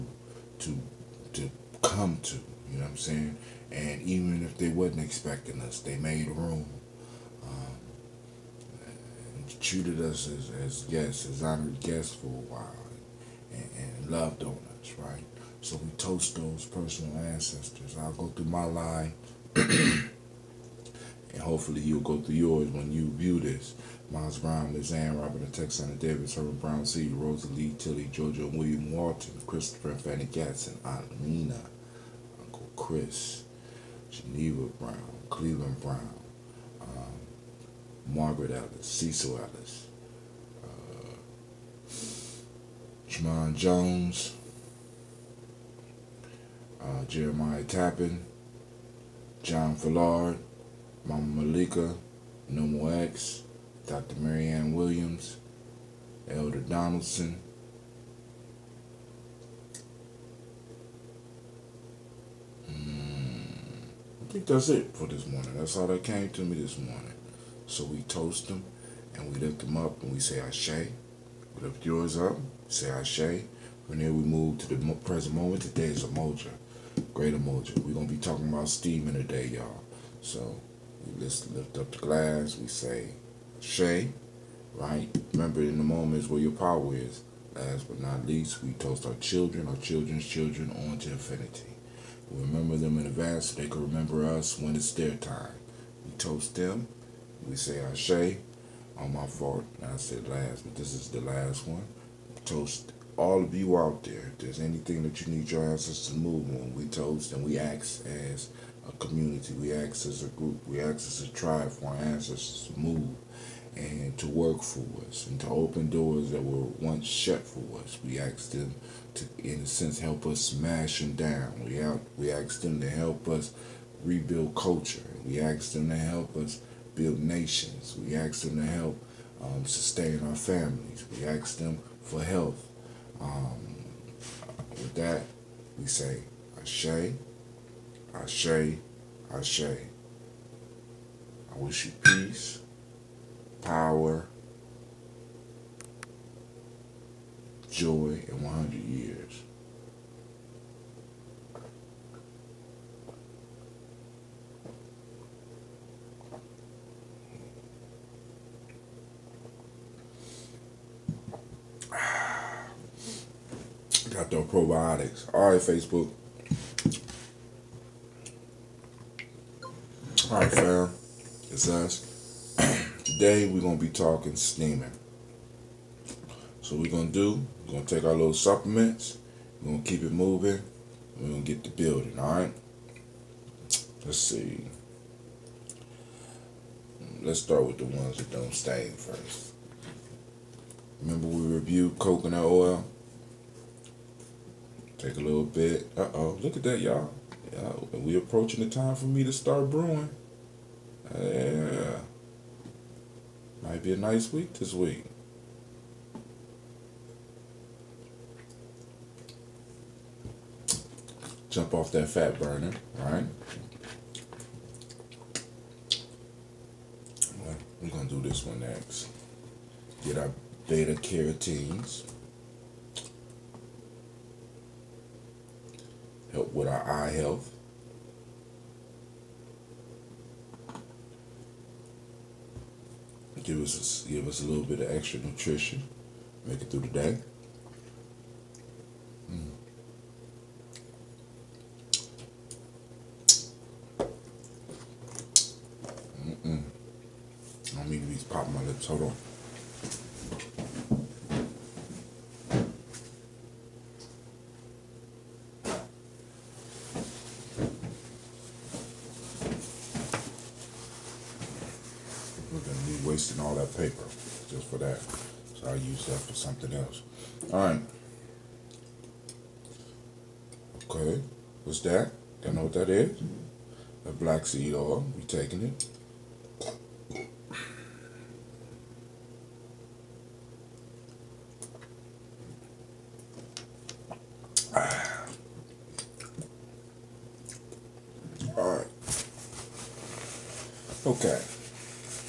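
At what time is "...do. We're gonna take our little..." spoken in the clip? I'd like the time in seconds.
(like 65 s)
177 s.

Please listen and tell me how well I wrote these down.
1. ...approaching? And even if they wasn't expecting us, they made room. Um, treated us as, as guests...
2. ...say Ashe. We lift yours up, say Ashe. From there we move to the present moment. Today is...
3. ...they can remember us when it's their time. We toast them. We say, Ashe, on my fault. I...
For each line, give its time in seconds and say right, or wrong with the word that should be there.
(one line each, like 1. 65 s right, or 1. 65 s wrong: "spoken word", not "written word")
1. 2 s wrong: "saying", not "approaching"
2. 70 s right
3. 93 s right.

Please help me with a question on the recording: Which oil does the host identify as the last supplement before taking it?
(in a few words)
Black seed oil.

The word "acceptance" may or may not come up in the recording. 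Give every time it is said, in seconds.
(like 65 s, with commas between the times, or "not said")
not said.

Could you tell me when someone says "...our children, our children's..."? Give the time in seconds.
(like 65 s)
89 s.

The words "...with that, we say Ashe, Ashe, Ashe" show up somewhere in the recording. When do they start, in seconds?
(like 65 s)
134 s.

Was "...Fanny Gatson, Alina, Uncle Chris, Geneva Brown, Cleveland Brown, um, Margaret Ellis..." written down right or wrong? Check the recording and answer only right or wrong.
right.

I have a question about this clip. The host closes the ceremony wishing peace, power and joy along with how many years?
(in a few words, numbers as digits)
100.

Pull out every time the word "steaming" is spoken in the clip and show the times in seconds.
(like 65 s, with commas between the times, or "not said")
78 s, 174 s.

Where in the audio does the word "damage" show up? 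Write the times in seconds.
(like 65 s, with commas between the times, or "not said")
not said.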